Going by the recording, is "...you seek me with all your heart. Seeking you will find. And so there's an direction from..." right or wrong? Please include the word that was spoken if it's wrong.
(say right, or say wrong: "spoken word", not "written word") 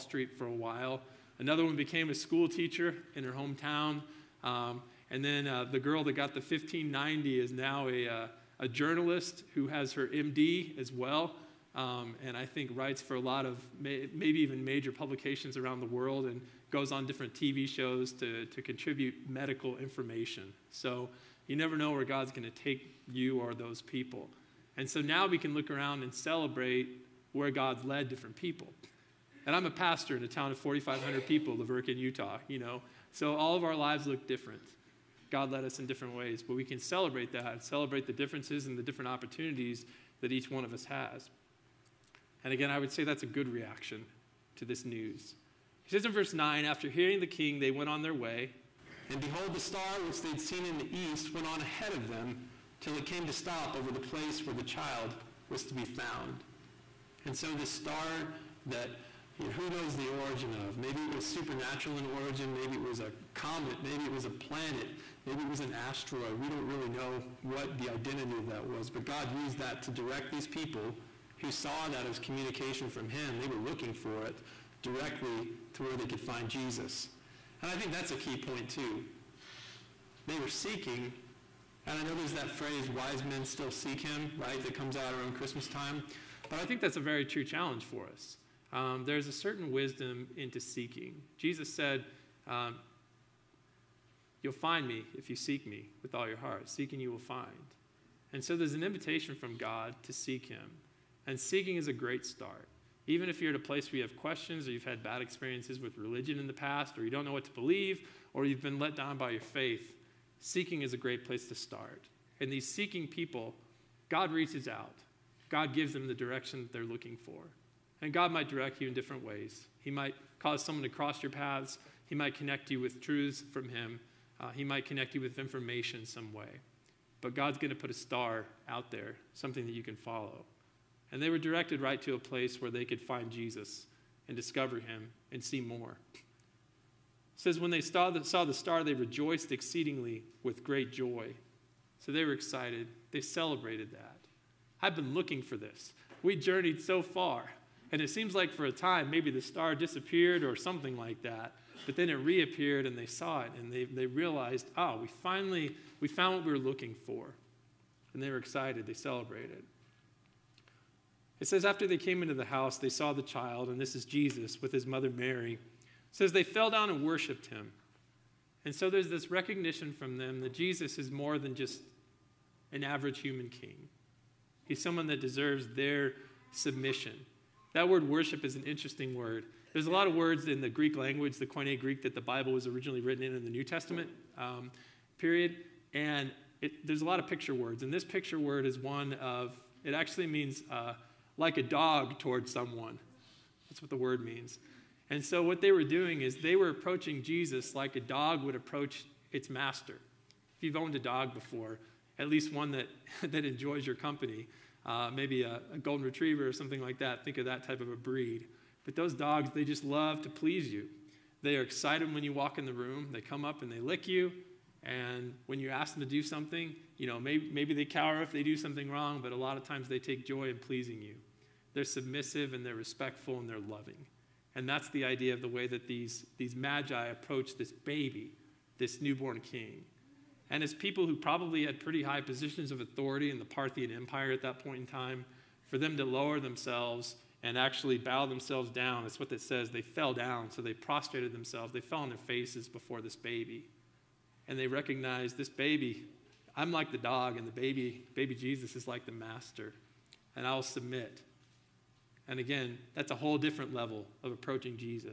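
wrong: "invitation", not "direction".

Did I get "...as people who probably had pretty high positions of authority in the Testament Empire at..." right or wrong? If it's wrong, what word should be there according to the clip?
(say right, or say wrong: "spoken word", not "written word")
wrong: "Parthian", not "Testament".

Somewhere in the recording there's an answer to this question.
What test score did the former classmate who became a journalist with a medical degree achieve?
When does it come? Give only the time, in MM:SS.
00:06.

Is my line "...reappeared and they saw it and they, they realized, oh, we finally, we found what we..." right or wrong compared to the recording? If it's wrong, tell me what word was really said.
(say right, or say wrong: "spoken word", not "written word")
right.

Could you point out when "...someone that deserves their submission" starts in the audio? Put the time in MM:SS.
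02:54.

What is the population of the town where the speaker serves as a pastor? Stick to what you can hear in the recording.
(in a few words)
4,500.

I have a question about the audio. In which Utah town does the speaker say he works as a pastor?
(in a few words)
La Verkin.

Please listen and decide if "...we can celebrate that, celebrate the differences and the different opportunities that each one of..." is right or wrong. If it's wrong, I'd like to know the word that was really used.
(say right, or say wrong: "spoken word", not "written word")
right.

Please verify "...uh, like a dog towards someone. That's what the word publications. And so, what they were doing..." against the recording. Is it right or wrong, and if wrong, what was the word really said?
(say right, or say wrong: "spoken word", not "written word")
wrong: "means", not "publications".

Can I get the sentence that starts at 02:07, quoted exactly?
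But God's going to put a star out there, something that you can follow.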